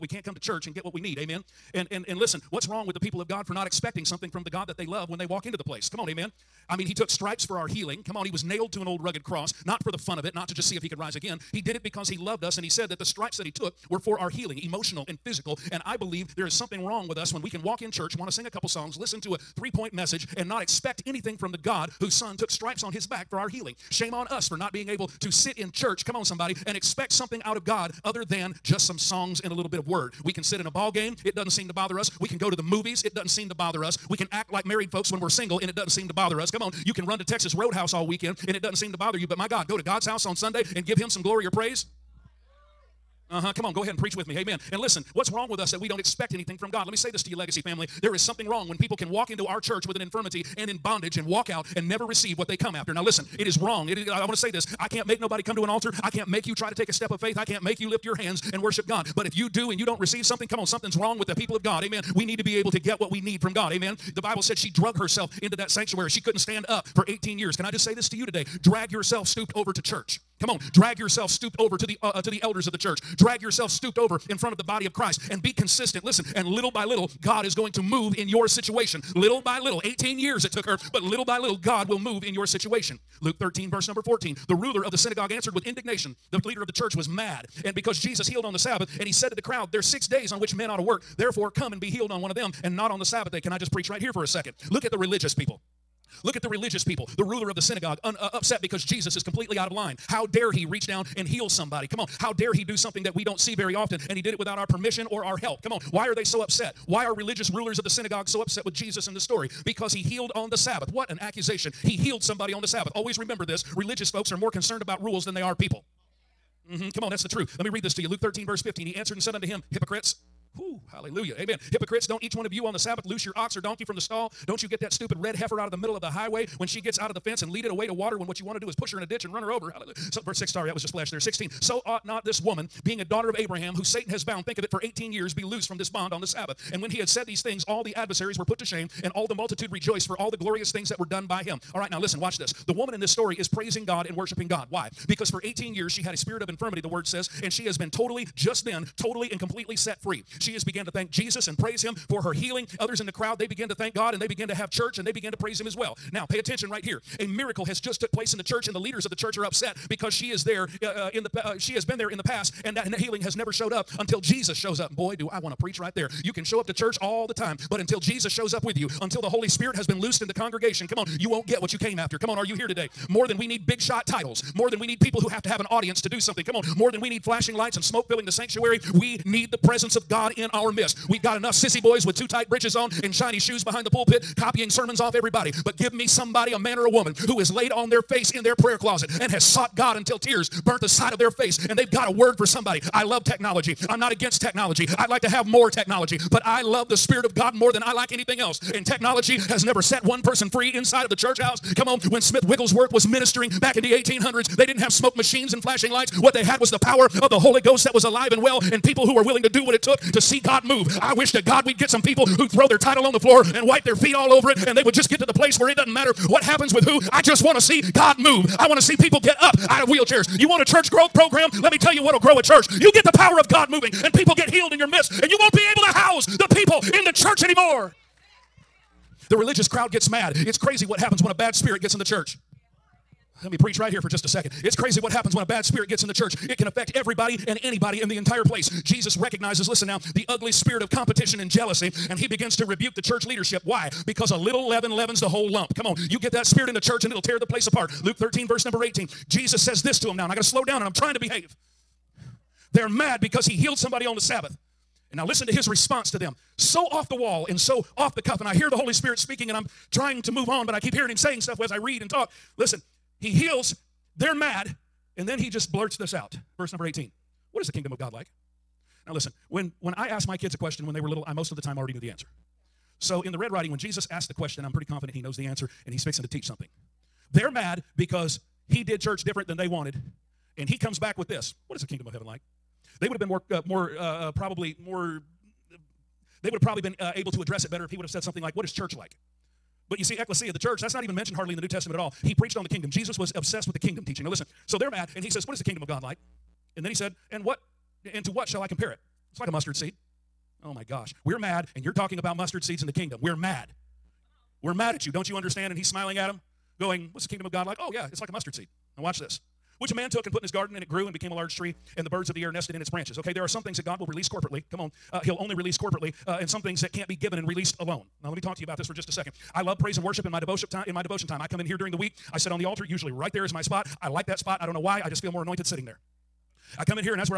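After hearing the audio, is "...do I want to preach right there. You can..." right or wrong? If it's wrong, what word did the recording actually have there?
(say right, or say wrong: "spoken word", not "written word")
right.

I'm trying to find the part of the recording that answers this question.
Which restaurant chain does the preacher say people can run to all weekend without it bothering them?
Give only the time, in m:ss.
0:37.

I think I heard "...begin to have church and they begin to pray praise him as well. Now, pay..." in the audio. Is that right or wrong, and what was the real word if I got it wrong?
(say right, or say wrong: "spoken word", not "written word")
right.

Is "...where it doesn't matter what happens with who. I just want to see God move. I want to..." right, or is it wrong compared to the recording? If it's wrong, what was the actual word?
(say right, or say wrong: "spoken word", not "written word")
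right.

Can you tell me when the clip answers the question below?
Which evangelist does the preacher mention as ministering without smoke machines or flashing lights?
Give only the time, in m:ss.
3:22.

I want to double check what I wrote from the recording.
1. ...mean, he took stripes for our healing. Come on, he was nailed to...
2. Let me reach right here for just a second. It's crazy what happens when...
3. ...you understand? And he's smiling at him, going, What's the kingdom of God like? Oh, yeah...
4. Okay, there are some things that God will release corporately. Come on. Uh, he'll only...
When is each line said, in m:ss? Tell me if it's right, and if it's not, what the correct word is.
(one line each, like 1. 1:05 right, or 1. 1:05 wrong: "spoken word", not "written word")
1. 0:06 right
2. 3:53 wrong: "preach", not "reach"
3. 5:05 right
4. 5:13 right.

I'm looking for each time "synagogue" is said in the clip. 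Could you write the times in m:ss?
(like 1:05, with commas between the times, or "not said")
1:24, 1:37, 1:47.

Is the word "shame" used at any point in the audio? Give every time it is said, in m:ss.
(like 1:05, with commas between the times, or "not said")
0:23, 2:18.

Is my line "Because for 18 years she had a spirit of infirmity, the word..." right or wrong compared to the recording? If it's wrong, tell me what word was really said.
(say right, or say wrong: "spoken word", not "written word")
right.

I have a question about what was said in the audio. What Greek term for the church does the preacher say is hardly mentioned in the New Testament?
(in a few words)
ecclesia.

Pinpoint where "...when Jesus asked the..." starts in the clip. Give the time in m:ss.
4:33.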